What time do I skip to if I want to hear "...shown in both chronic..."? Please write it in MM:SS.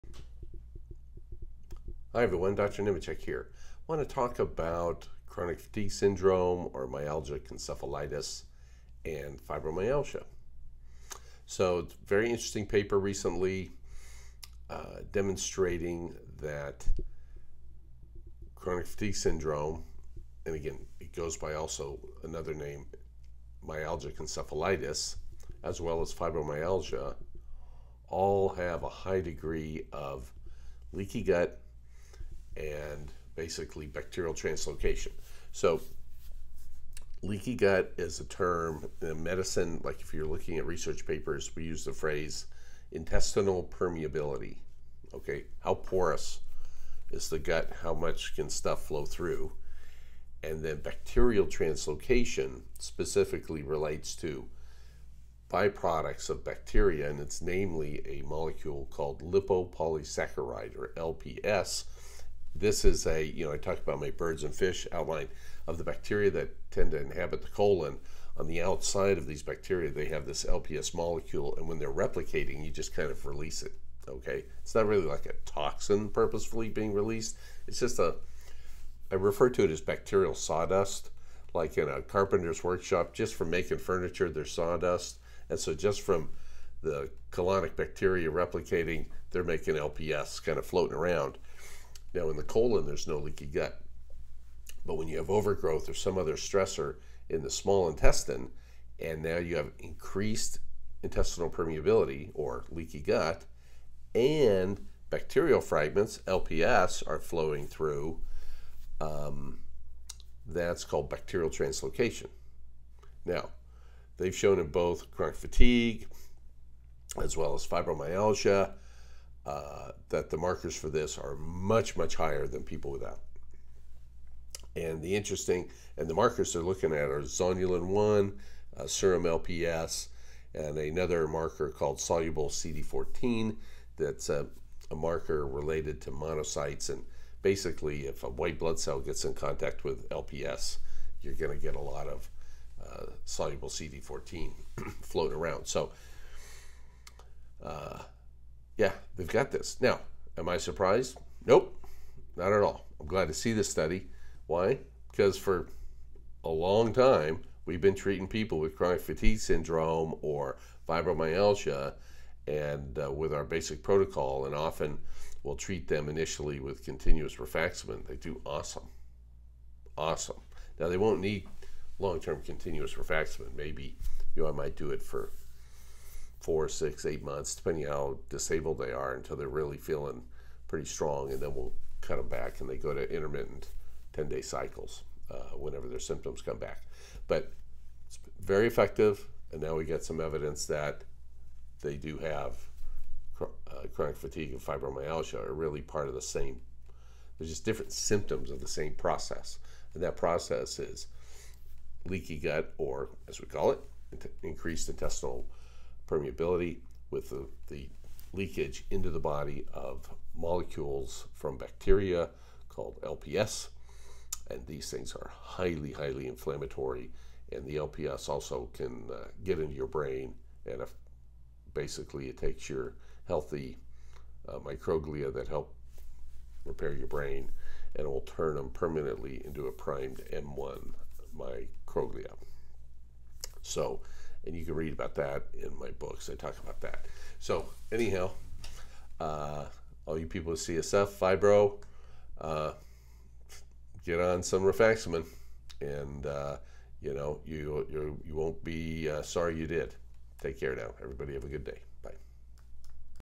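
01:54.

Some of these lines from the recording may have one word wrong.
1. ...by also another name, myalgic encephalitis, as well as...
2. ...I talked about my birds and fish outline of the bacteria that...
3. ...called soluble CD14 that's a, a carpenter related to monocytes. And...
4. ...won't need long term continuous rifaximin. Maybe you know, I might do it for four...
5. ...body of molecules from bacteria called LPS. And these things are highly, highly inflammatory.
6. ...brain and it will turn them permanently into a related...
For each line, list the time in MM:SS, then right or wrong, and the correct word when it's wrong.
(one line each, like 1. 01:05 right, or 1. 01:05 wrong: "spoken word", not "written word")
1. 00:21 right
2. 01:03 right
3. 02:11 wrong: "marker", not "carpenter"
4. 02:50 right
5. 03:29 right
6. 03:47 wrong: "primed", not "related".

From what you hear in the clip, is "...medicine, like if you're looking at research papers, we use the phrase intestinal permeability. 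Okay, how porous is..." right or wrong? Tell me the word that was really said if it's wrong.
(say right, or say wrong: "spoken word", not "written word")
right.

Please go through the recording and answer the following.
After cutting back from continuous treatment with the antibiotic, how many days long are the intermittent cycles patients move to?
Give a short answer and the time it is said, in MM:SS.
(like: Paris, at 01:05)
10, at 03:04.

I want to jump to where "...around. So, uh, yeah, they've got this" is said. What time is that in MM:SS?
02:25.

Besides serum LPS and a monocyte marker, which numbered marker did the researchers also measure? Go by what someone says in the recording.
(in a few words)
zonulin 1.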